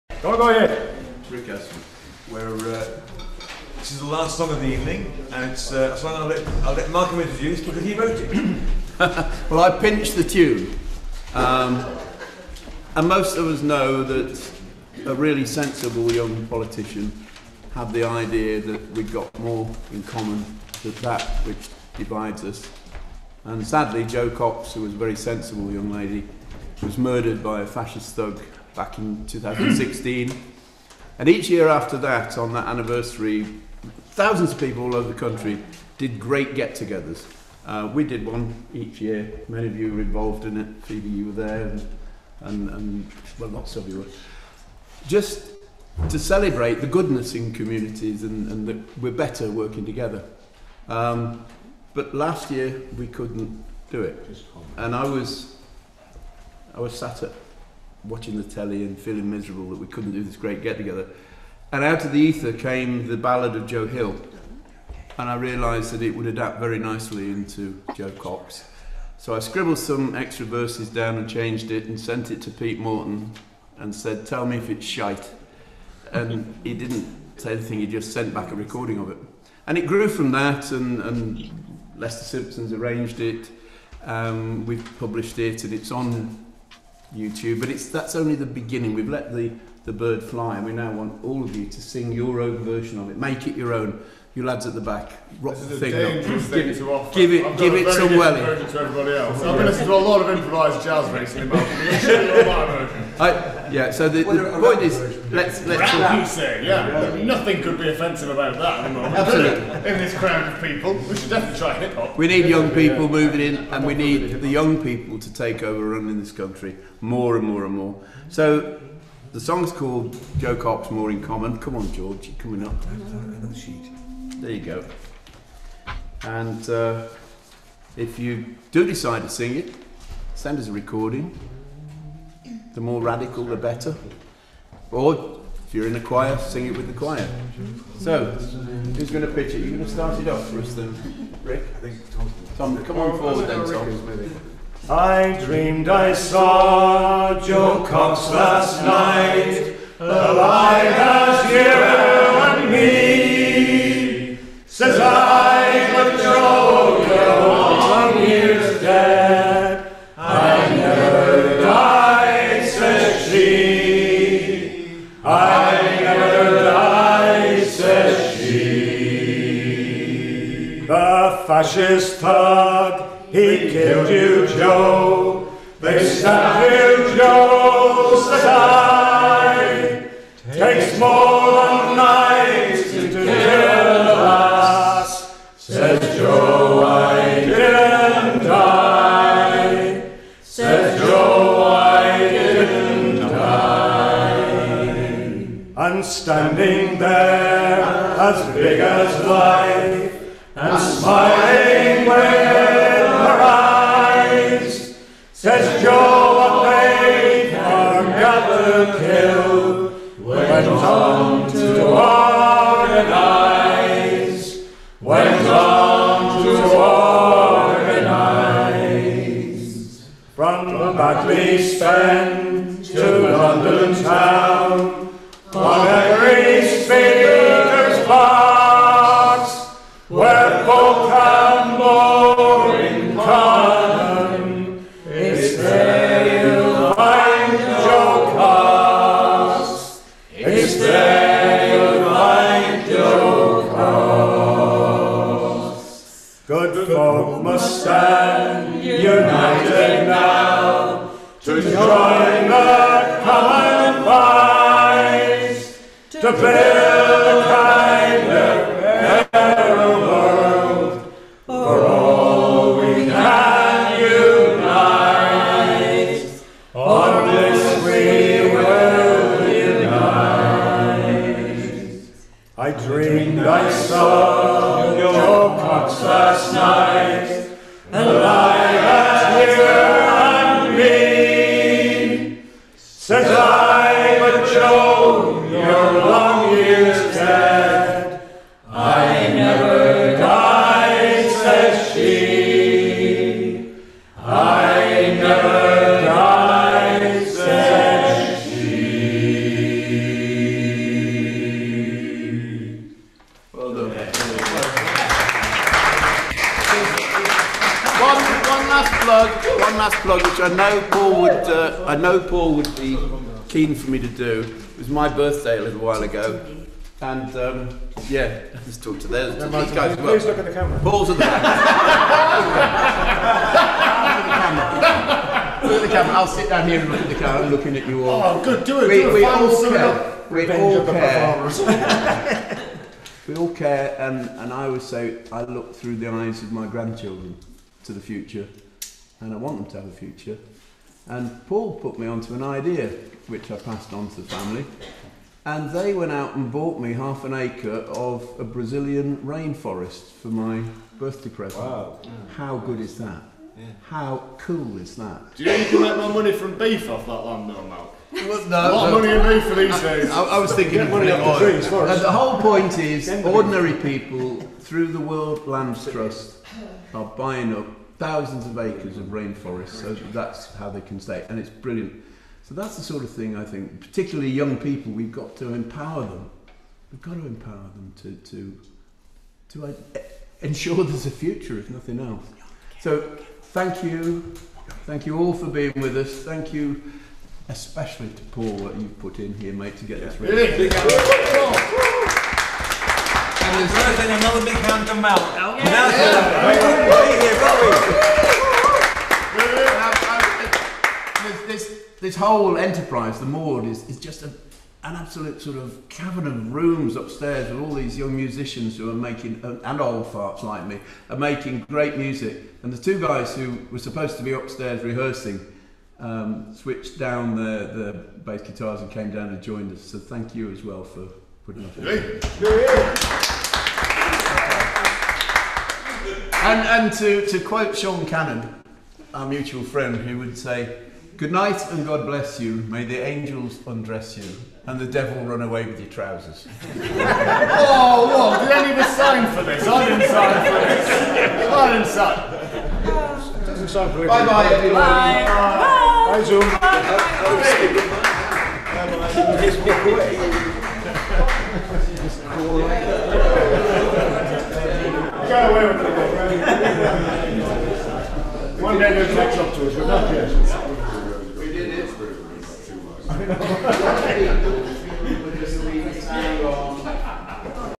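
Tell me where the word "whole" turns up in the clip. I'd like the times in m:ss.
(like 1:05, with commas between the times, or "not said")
6:02, 6:42.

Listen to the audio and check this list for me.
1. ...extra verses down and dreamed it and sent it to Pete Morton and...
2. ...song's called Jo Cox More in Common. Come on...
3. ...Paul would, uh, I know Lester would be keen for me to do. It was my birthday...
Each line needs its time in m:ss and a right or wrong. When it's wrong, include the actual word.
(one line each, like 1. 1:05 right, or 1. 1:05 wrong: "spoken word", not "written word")
1. 1:10 wrong: "changed", not "dreamed"
2. 1:59 right
3. 5:10 wrong: "Paul", not "Lester".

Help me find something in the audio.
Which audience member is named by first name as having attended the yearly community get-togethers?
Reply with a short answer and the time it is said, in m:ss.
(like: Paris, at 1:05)
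Phoebe, at 0:40.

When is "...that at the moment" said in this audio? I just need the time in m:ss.
1:48.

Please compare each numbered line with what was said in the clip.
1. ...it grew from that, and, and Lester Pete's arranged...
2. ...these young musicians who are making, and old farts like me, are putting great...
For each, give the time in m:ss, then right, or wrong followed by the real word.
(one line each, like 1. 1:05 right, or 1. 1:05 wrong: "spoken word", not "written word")
1. 1:19 wrong: "Simpson", not "Pete"
2. 6:47 wrong: "making", not "putting".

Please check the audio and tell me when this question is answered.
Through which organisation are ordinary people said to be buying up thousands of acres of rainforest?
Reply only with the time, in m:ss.
6:04.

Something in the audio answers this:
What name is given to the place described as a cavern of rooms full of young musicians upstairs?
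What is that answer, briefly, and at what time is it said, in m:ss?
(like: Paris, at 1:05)
the Maud, at 6:43.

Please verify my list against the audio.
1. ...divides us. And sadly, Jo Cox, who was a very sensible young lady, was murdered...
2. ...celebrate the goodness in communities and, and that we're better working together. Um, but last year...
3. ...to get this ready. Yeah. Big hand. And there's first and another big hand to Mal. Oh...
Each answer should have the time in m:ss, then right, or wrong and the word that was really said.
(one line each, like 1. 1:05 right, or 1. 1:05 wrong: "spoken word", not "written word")
1. 0:21 right
2. 0:46 right
3. 6:29 right.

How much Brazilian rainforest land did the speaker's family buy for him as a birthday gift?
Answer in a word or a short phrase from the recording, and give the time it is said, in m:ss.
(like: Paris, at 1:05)
half an acre, at 5:46.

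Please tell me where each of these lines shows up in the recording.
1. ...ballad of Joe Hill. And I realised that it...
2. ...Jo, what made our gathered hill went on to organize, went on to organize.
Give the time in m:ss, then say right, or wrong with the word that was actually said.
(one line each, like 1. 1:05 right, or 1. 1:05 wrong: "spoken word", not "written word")
1. 1:03 right
2. 3:25 right.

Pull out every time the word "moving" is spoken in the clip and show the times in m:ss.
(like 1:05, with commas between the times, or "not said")
1:53.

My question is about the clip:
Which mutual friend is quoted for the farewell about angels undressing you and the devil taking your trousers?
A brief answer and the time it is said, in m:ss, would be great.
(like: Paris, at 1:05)
Sean Cannon, at 7:07.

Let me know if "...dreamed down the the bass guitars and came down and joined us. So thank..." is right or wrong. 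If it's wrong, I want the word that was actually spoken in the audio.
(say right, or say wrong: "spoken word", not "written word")
wrong: "switched", not "dreamed".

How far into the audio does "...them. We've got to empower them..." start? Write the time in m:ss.
6:16.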